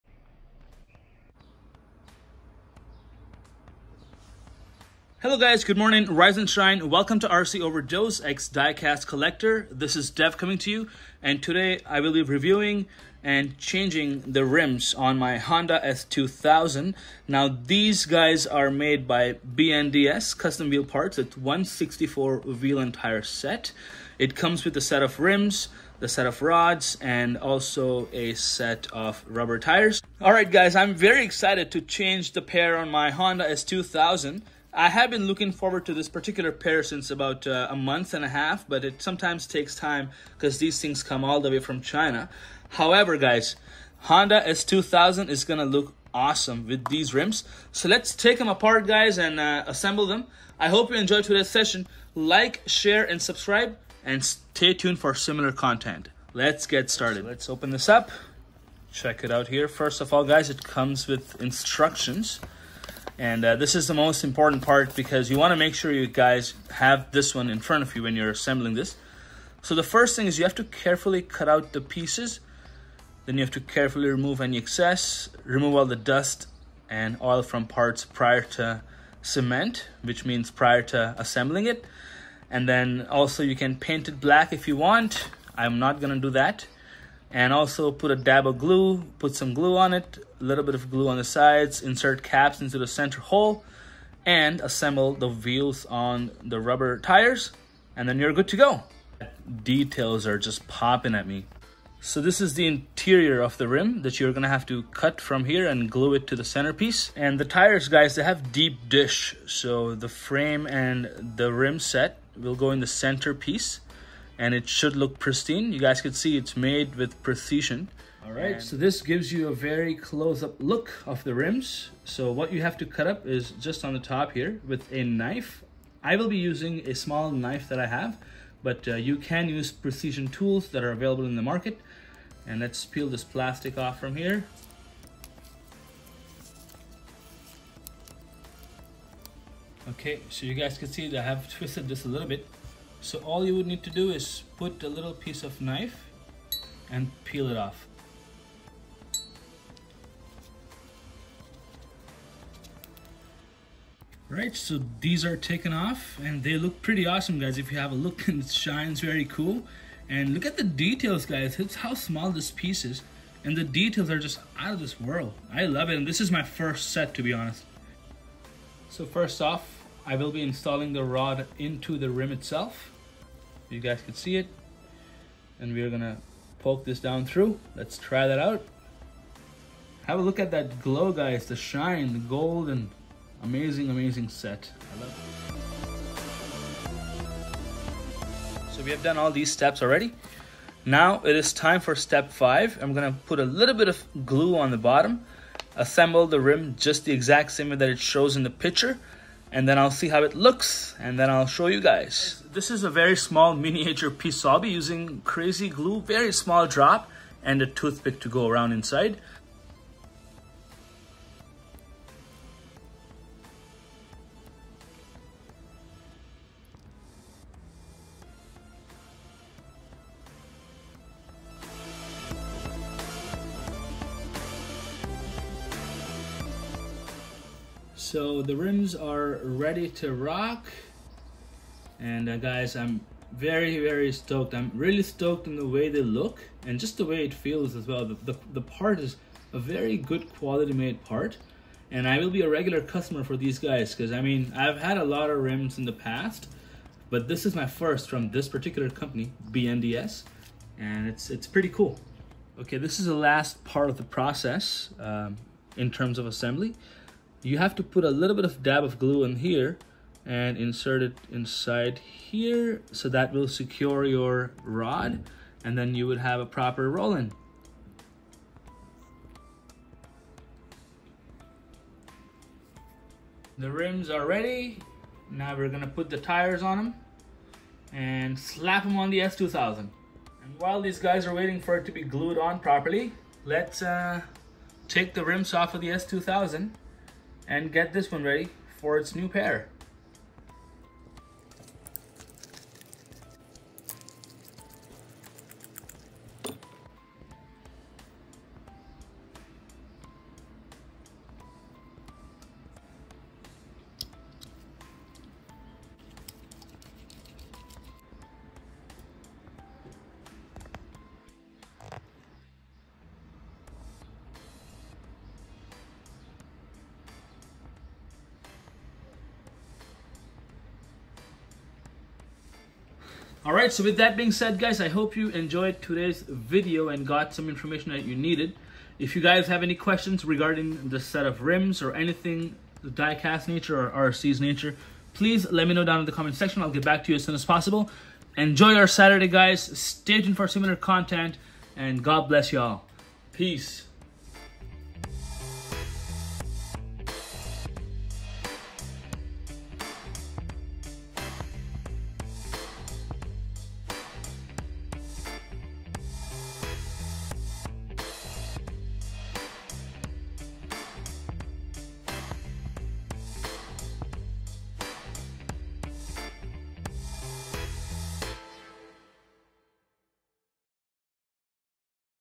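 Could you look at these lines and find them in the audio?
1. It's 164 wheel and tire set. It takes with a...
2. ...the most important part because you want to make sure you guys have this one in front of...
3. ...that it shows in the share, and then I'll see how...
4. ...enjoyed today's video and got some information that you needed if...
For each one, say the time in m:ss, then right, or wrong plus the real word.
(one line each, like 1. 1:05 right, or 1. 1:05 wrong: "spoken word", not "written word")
1. 0:21 wrong: "comes", not "takes"
2. 1:03 right
3. 3:17 wrong: "picture", not "share"
4. 5:25 right.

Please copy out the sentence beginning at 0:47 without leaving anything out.
So let's take them apart, guys, and uh, assemble them.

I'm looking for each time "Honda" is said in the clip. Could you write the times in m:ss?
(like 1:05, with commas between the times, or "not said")
0:15, 0:33, 0:44.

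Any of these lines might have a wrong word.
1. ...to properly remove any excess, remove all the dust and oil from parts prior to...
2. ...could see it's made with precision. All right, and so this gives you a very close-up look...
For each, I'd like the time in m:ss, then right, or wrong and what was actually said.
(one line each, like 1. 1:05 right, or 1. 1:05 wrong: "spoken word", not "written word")
1. 1:13 wrong: "carefully", not "properly"
2. 1:56 right.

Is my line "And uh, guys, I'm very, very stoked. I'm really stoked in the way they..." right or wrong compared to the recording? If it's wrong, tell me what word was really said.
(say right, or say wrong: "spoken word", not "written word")
right.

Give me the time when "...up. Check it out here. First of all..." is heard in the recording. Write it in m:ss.
0:57.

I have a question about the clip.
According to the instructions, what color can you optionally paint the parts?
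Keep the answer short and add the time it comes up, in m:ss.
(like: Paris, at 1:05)
black, at 1:24.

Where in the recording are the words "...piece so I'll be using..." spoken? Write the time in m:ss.
3:24.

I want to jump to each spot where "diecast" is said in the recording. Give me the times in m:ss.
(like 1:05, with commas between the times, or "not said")
0:08, 5:32.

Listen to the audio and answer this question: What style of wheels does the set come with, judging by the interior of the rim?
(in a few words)
deep dish.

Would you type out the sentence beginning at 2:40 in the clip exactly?
And look at the details guys, it's how small this piece is.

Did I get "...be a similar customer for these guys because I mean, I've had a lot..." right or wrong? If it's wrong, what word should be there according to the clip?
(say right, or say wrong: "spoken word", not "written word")
wrong: "regular", not "similar".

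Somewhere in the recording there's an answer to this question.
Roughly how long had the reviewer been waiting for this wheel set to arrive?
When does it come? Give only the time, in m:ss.
0:37.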